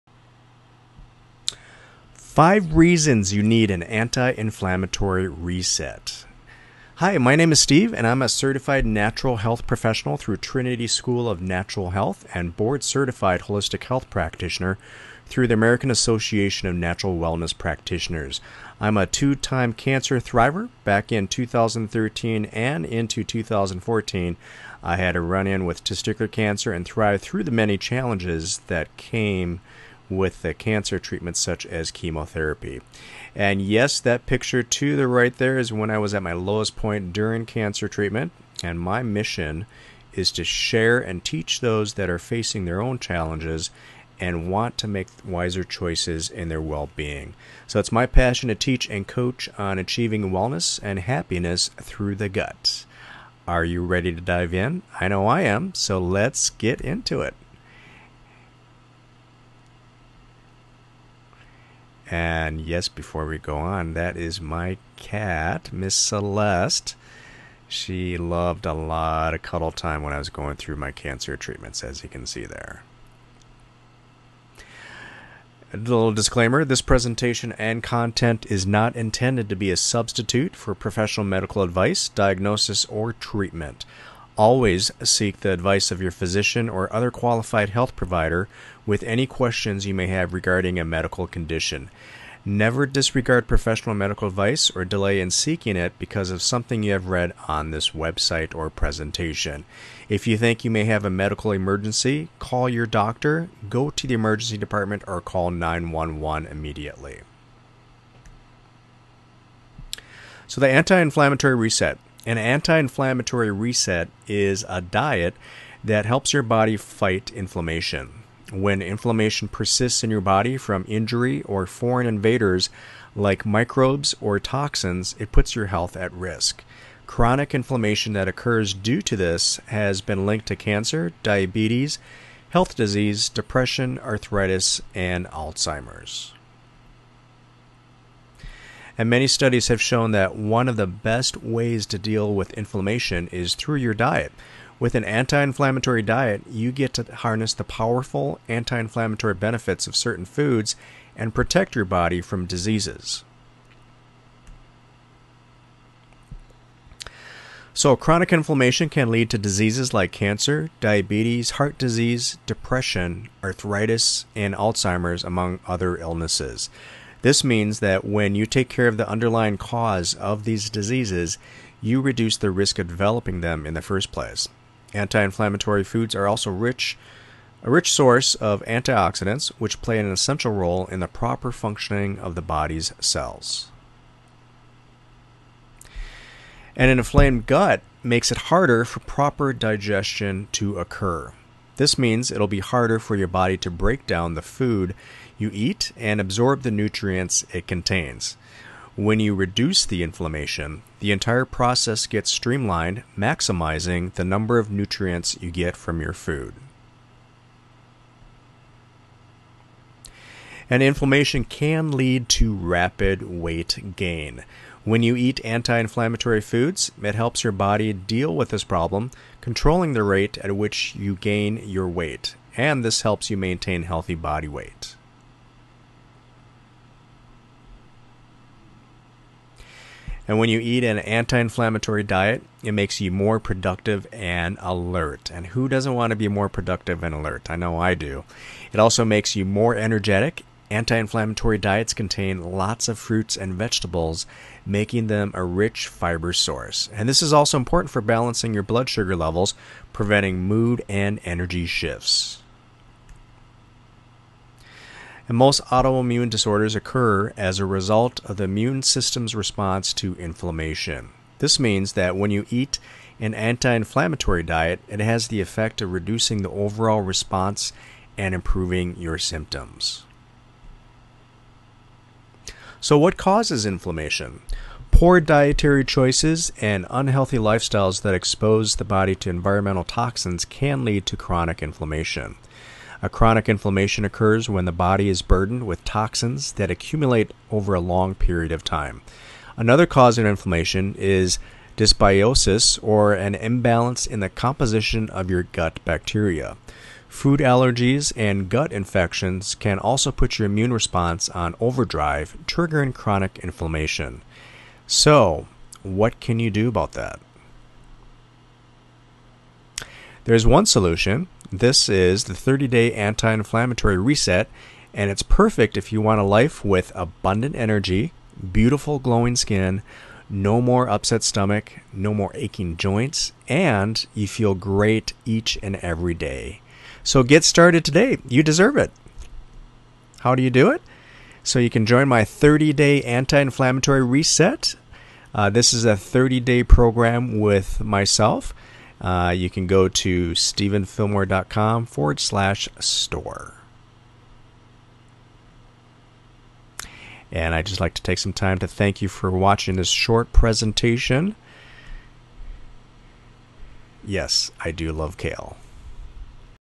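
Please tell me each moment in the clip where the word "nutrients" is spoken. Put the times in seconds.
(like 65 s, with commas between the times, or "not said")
196 s, 204 s.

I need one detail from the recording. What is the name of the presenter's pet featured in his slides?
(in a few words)
Miss Celeste.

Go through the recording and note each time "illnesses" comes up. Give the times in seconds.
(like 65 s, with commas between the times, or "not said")
165 s.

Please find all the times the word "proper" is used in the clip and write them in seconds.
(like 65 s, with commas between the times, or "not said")
181 s, 189 s.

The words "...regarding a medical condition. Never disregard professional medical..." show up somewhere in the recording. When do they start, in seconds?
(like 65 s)
90 s.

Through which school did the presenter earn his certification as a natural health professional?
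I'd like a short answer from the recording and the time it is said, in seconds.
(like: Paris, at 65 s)
Trinity School of Natural Health, at 10 s.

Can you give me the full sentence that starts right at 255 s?
And most autoimmune disorders occur as a result of the immune system's response to inflammation.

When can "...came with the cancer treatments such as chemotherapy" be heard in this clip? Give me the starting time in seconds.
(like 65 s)
28 s.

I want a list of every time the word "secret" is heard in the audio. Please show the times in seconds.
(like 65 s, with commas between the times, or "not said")
not said.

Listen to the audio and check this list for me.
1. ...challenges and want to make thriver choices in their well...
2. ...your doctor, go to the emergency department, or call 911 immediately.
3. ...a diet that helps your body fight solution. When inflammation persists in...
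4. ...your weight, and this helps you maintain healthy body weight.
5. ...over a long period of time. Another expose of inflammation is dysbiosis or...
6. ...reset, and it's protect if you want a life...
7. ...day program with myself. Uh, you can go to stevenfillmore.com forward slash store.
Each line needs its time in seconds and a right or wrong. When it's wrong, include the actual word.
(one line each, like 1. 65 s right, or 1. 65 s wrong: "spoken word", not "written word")
1. 42 s wrong: "wiser", not "thriver"
2. 102 s right
3. 114 s wrong: "inflammation", not "solution"
4. 221 s right
5. 287 s wrong: "cause", not "expose"
6. 313 s wrong: "perfect", not "protect"
7. 336 s right.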